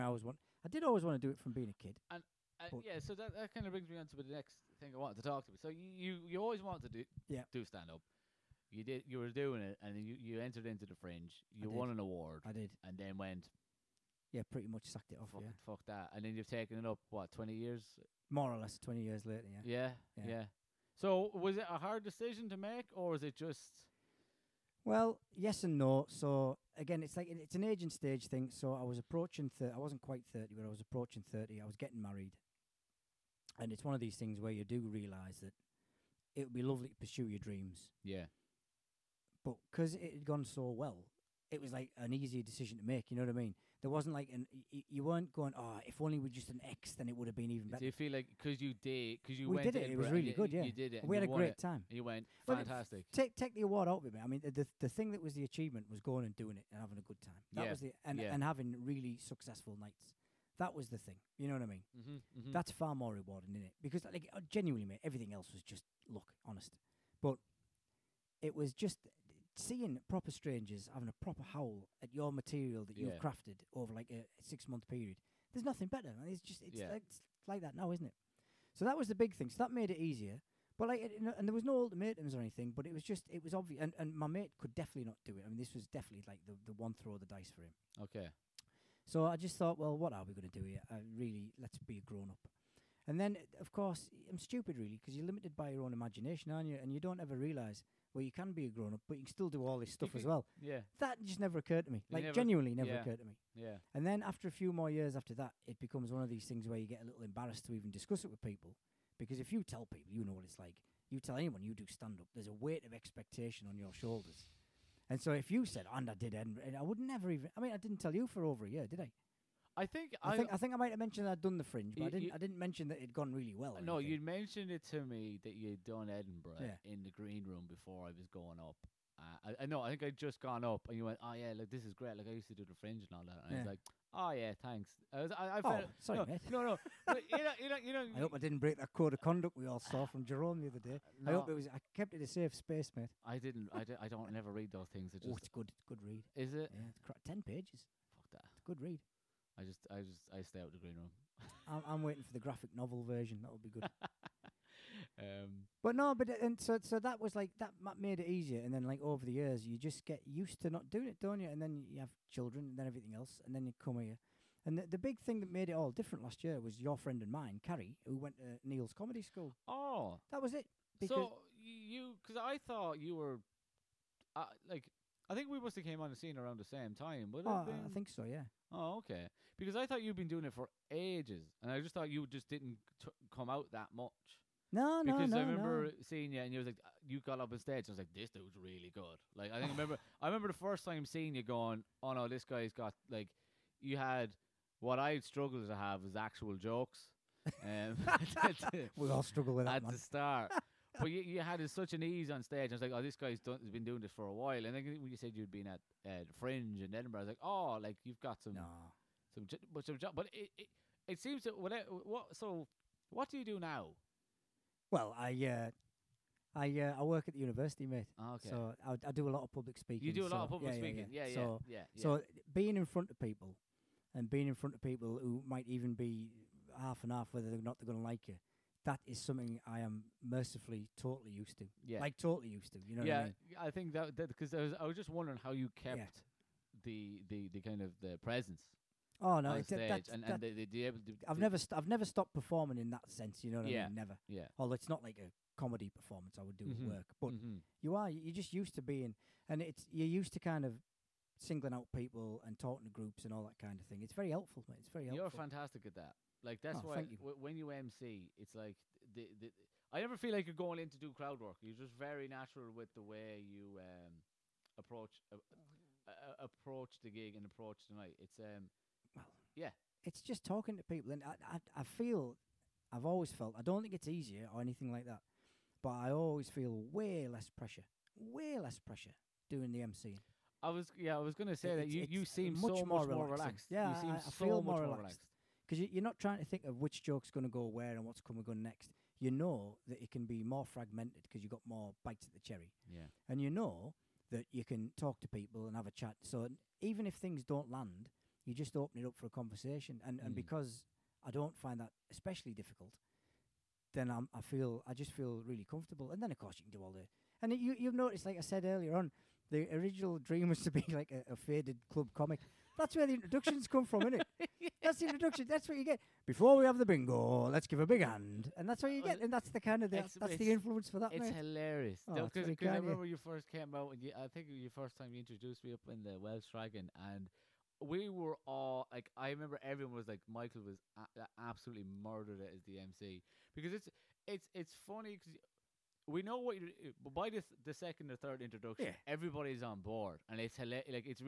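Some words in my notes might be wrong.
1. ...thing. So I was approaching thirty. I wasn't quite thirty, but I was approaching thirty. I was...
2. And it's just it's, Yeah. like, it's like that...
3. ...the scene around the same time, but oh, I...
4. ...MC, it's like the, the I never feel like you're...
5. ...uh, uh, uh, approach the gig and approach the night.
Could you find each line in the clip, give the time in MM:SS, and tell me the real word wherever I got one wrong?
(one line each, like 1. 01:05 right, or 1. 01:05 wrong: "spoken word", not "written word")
1. 00:28 right
2. 01:16 right
3. 02:56 right
4. 04:17 right
5. 04:25 right.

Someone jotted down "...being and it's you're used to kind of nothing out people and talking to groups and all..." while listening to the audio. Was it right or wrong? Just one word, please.
wrong.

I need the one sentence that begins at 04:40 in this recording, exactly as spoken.
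I was yeah, I was gonna say that you, you seem much so more much more relaxed.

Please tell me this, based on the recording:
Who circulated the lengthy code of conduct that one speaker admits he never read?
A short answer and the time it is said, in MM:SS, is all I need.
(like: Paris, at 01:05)
Jerome, at 02:20.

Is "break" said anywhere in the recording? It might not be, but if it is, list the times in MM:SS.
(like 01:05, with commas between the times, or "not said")
02:18.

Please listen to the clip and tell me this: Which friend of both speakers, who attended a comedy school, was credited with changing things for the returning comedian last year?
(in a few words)
Carrie.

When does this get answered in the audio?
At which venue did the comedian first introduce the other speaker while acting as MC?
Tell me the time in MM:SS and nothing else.
05:26.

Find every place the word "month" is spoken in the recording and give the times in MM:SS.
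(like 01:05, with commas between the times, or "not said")
01:14.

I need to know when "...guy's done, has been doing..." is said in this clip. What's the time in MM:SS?
03:23.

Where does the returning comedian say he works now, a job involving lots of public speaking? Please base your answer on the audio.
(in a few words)
The university.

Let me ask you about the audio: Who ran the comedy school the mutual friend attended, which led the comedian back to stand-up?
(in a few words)
Neil.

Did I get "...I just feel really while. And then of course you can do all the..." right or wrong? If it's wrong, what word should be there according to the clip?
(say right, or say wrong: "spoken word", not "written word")
wrong: "comfortable", not "while".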